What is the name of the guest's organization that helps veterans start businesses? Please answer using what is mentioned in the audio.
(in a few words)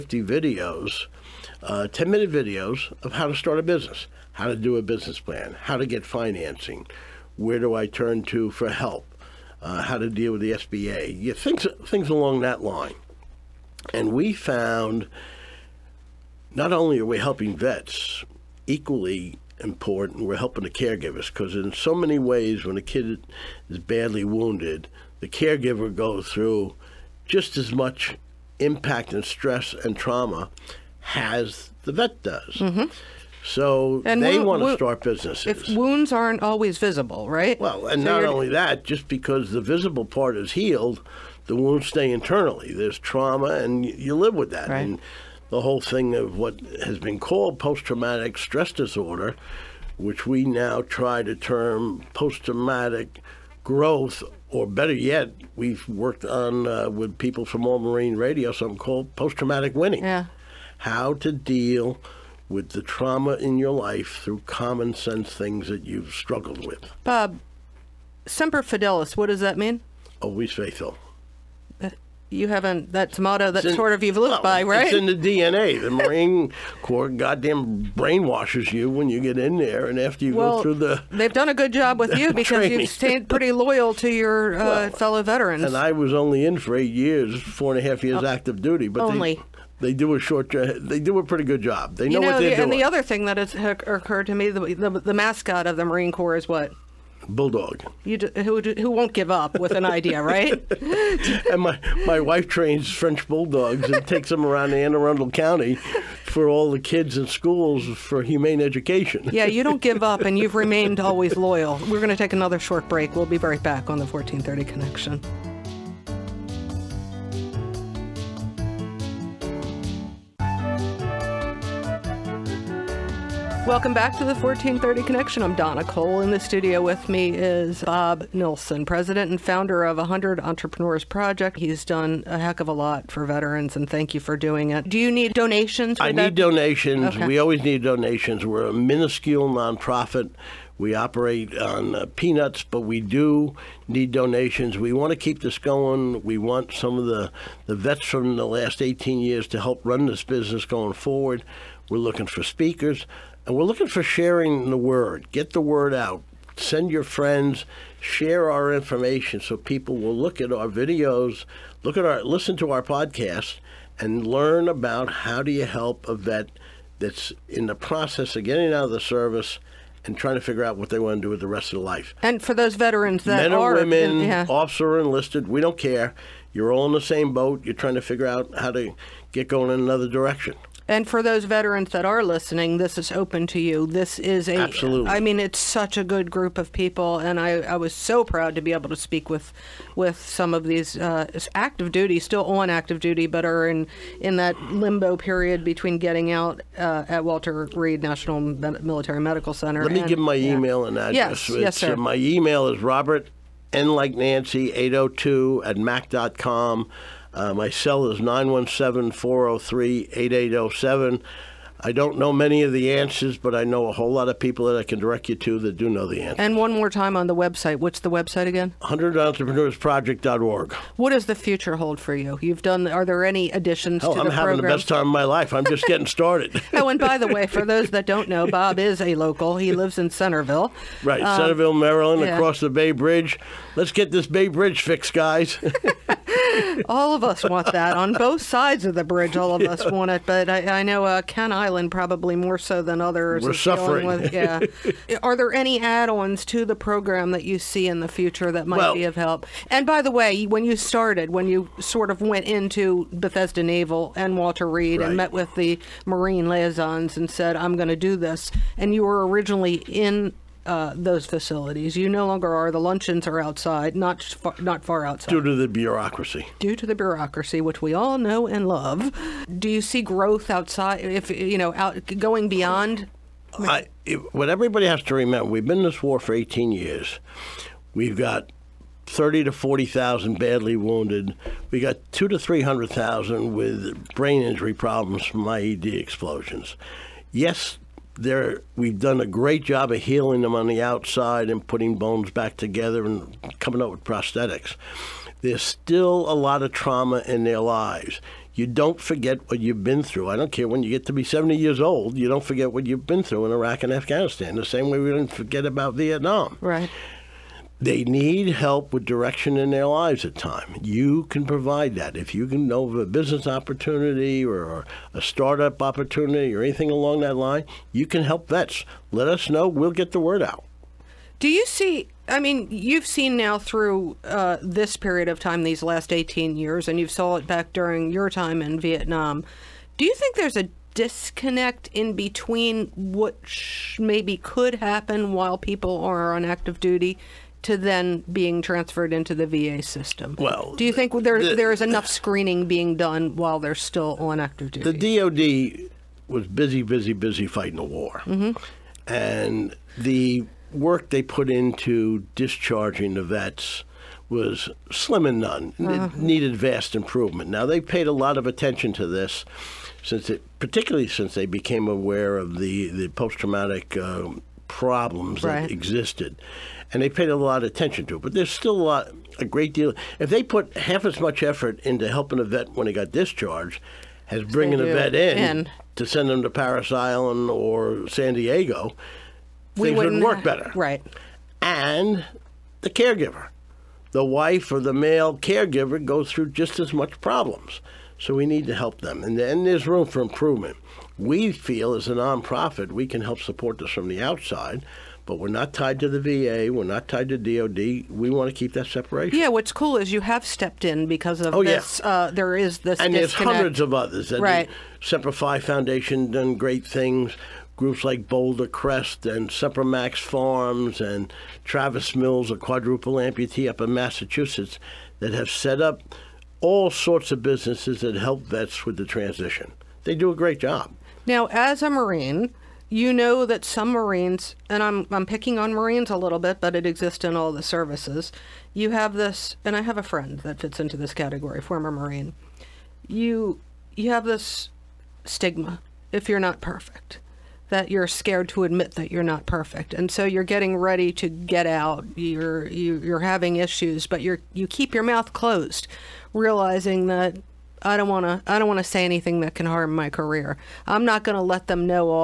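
100 Entrepreneurs Project.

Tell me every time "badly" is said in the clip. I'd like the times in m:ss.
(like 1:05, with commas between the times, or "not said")
0:23, 4:40.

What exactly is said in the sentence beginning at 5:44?
The DoD was busy, busy, busy fighting the war, mm-hmm.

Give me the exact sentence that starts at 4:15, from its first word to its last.
and met with the Marine liaisons and said, "I'm going to do this," and you were originally in uh, those facilities.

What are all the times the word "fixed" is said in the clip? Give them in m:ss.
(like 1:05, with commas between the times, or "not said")
3:54.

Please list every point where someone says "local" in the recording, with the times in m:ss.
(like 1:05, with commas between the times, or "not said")
3:49.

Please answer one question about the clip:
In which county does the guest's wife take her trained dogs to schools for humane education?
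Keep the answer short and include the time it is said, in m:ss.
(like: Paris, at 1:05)
Anne Arundel County, at 1:44.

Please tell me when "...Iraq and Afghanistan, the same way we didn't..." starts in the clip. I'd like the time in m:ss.
5:03.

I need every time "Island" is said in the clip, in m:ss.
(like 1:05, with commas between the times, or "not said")
4:01, 6:16.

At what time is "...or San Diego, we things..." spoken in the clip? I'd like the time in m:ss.
6:17.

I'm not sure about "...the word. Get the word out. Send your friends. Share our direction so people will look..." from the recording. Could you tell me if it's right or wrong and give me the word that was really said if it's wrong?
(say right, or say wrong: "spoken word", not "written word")
wrong: "information", not "direction".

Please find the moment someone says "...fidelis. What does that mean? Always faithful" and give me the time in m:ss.
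1:08.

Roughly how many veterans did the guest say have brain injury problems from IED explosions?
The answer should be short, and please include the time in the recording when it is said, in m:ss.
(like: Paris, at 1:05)
200,000 to 300,000, at 4:42.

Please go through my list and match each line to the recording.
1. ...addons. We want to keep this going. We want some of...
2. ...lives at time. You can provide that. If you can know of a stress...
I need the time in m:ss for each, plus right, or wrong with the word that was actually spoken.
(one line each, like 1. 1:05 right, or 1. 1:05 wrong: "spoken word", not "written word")
1. 2:24 wrong: "donations", not "addons"
2. 5:09 wrong: "business", not "stress".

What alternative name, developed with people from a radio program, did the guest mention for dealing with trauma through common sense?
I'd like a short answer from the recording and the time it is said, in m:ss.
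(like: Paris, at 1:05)
post-traumatic winning, at 0:59.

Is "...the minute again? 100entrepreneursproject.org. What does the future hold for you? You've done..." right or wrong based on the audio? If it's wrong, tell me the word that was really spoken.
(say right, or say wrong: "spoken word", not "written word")
wrong: "website", not "minute".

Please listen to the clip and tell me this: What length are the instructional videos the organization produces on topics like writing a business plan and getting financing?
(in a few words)
10 minutes.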